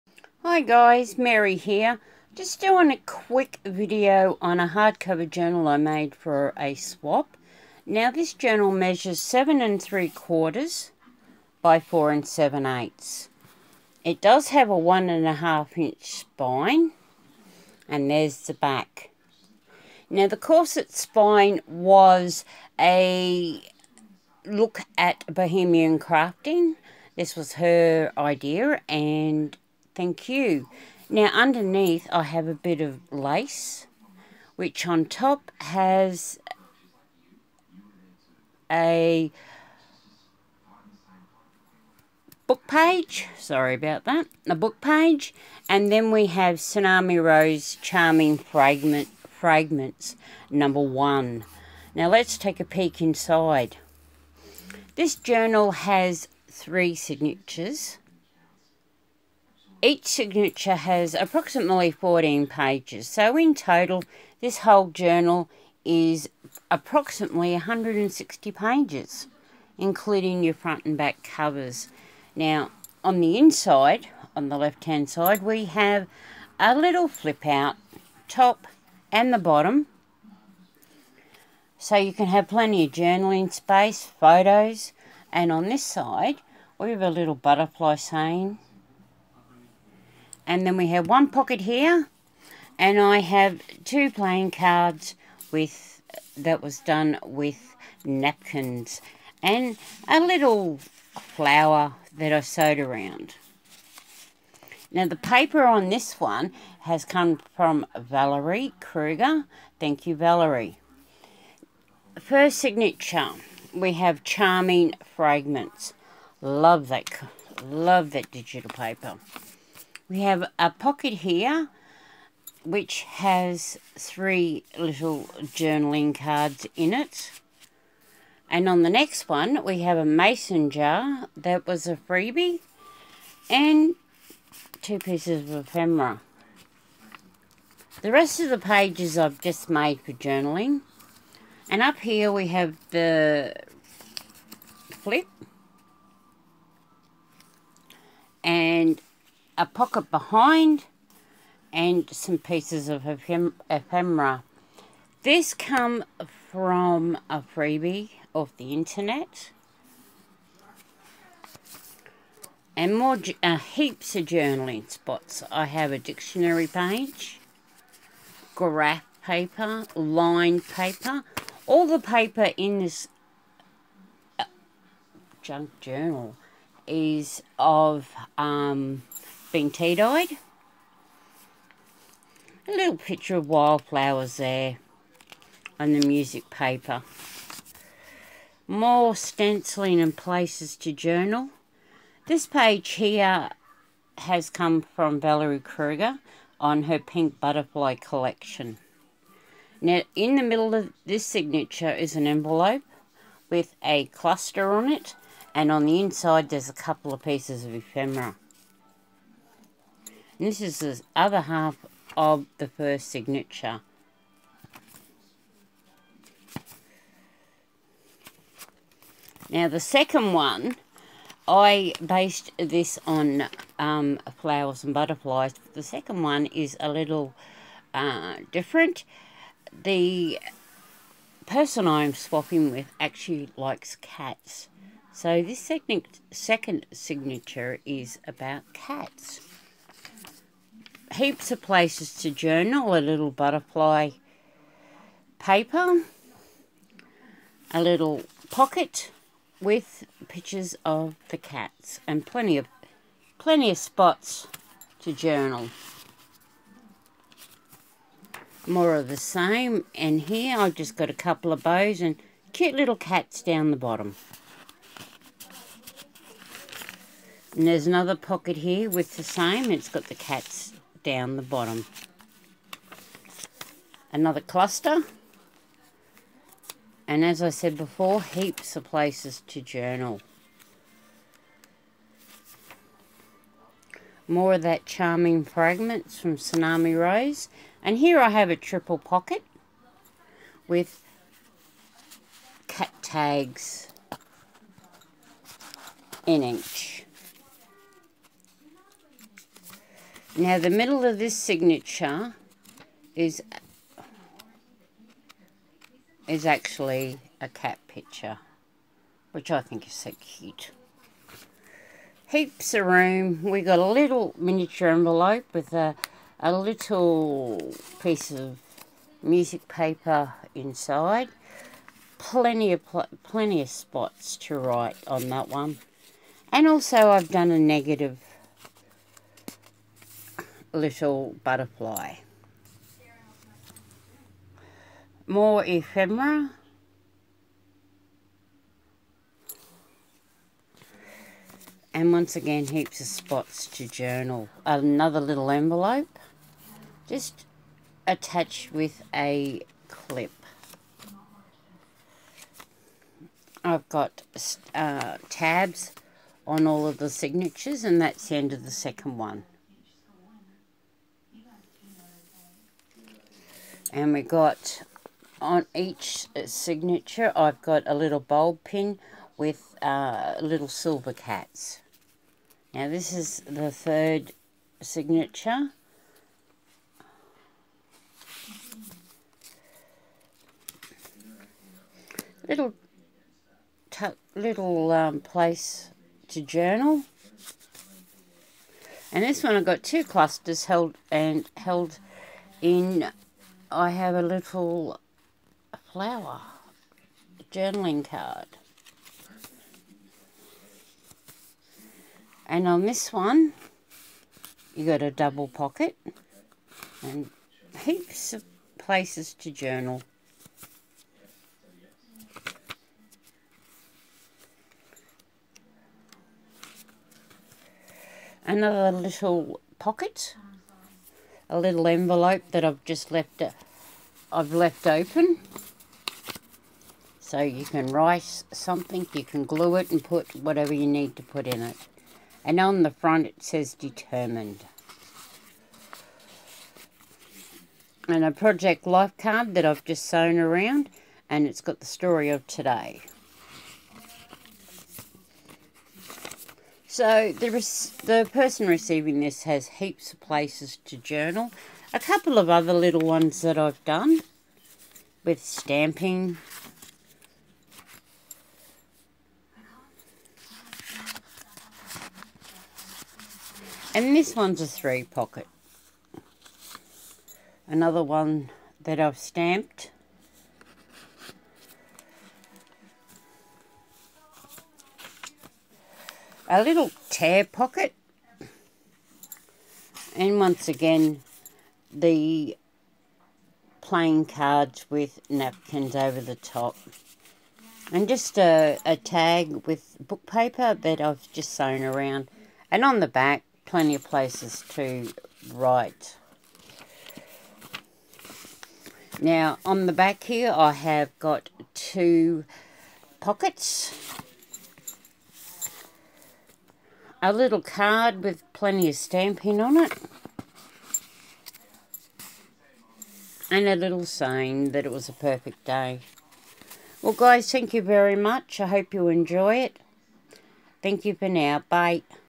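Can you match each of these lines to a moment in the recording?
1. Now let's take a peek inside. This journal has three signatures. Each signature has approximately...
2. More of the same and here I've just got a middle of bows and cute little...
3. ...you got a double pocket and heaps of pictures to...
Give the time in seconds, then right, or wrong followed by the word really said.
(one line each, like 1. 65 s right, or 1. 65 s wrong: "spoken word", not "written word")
1. 51 s right
2. 258 s wrong: "couple", not "middle"
3. 404 s wrong: "places", not "pictures".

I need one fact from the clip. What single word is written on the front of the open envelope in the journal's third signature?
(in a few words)
determined.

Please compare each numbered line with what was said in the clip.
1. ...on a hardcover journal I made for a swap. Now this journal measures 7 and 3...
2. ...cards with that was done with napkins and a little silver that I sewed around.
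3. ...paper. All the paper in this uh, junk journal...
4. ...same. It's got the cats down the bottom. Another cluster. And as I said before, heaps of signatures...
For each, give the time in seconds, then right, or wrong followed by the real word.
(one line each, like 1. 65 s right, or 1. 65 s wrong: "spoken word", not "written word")
1. 4 s right
2. 94 s wrong: "flower", not "silver"
3. 170 s right
4. 269 s wrong: "places", not "signatures".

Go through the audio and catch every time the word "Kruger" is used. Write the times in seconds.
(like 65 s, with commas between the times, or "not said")
108 s, 195 s.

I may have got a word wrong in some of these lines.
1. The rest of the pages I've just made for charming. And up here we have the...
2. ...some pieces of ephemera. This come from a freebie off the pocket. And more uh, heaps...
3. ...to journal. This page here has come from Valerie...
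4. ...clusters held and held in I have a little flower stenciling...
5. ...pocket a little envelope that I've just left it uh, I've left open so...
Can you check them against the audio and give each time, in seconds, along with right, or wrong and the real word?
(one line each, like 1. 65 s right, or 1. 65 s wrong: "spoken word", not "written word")
1. 138 s wrong: "journaling", not "charming"
2. 152 s wrong: "internet", not "pocket"
3. 190 s right
4. 390 s wrong: "journaling", not "stenciling"
5. 419 s right.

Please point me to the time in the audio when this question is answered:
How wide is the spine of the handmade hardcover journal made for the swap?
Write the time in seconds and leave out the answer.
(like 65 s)
14 s.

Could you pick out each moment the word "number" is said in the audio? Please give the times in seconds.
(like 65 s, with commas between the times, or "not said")
50 s.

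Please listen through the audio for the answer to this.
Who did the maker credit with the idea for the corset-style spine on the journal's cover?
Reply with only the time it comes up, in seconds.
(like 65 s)
25 s.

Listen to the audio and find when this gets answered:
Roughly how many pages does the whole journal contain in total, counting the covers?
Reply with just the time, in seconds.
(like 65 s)
67 s.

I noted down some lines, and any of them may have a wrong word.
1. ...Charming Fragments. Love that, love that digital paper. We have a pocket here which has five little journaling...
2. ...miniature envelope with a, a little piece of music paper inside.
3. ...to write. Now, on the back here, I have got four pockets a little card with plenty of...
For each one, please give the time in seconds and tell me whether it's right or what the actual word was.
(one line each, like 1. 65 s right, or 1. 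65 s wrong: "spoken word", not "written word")
1. 114 s wrong: "three", not "five"
2. 314 s right
3. 494 s wrong: "two", not "four".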